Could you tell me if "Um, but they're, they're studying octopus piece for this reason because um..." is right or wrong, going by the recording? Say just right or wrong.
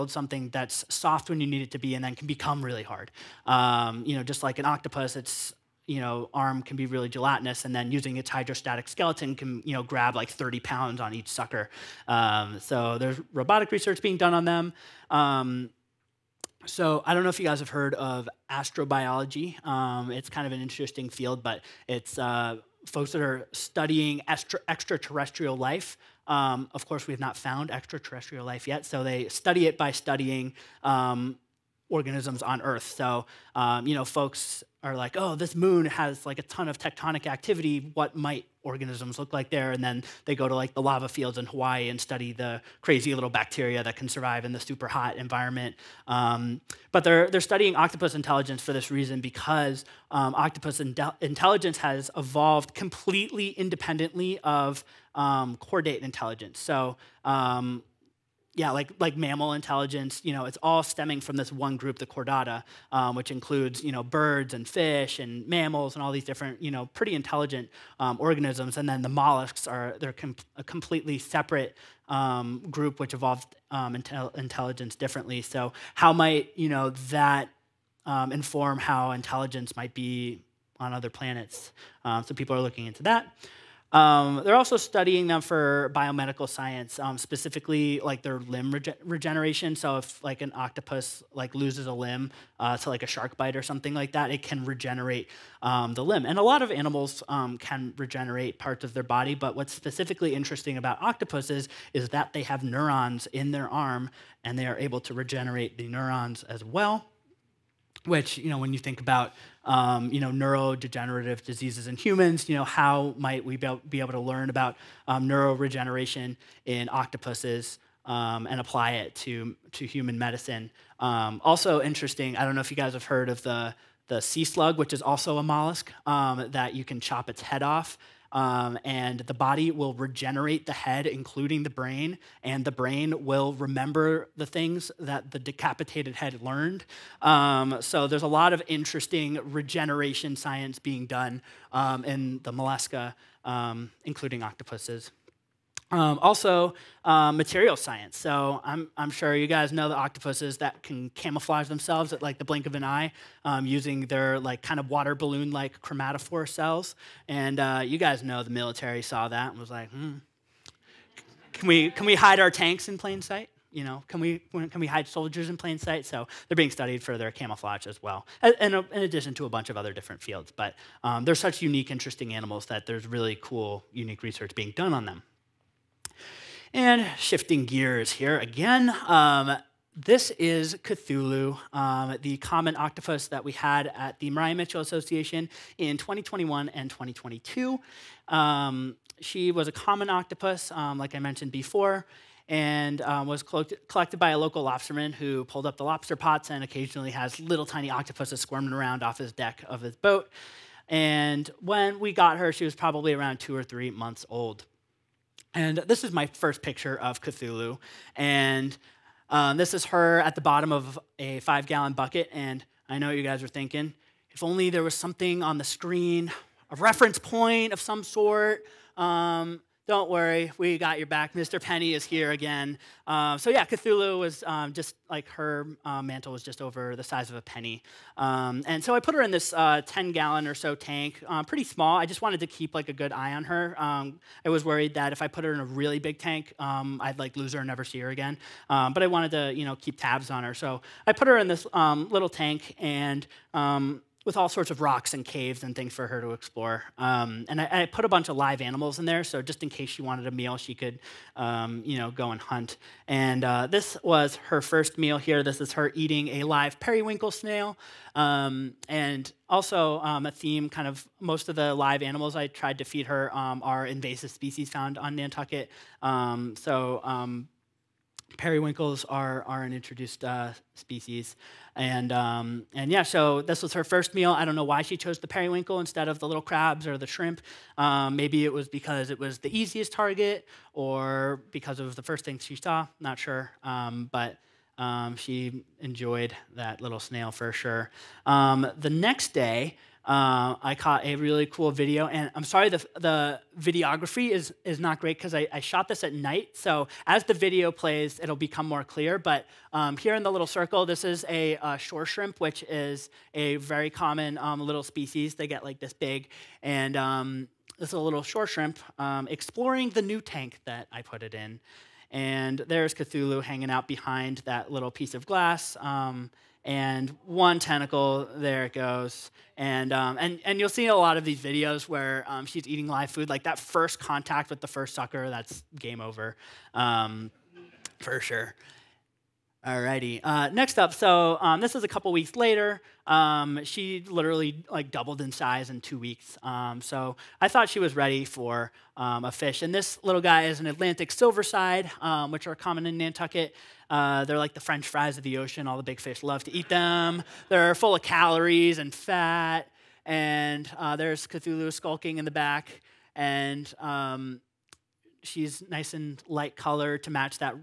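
wrong.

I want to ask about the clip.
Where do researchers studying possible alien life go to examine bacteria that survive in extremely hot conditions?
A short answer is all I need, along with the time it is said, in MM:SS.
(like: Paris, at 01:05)
Hawaii, at 00:40.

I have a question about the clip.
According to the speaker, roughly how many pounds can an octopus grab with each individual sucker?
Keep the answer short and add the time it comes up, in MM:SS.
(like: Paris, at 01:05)
30 pounds, at 00:10.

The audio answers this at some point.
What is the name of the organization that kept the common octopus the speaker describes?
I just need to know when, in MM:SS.
03:04.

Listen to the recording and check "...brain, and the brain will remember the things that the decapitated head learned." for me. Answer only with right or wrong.
right.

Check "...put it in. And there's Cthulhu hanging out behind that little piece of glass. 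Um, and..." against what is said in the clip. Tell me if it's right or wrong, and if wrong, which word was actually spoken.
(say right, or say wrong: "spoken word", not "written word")
right.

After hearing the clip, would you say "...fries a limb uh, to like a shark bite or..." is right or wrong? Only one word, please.
wrong.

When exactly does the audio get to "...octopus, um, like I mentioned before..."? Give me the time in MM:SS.
03:10.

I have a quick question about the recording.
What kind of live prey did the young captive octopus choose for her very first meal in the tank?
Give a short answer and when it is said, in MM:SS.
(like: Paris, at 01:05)
periwinkle snail, at 04:16.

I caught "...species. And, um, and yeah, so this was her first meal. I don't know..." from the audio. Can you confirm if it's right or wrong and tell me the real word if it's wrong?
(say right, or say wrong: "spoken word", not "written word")
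right.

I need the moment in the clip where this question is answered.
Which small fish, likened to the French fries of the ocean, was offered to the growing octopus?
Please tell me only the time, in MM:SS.
05:40.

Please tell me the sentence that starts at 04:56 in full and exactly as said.
So as the video plays, it'll become more clear.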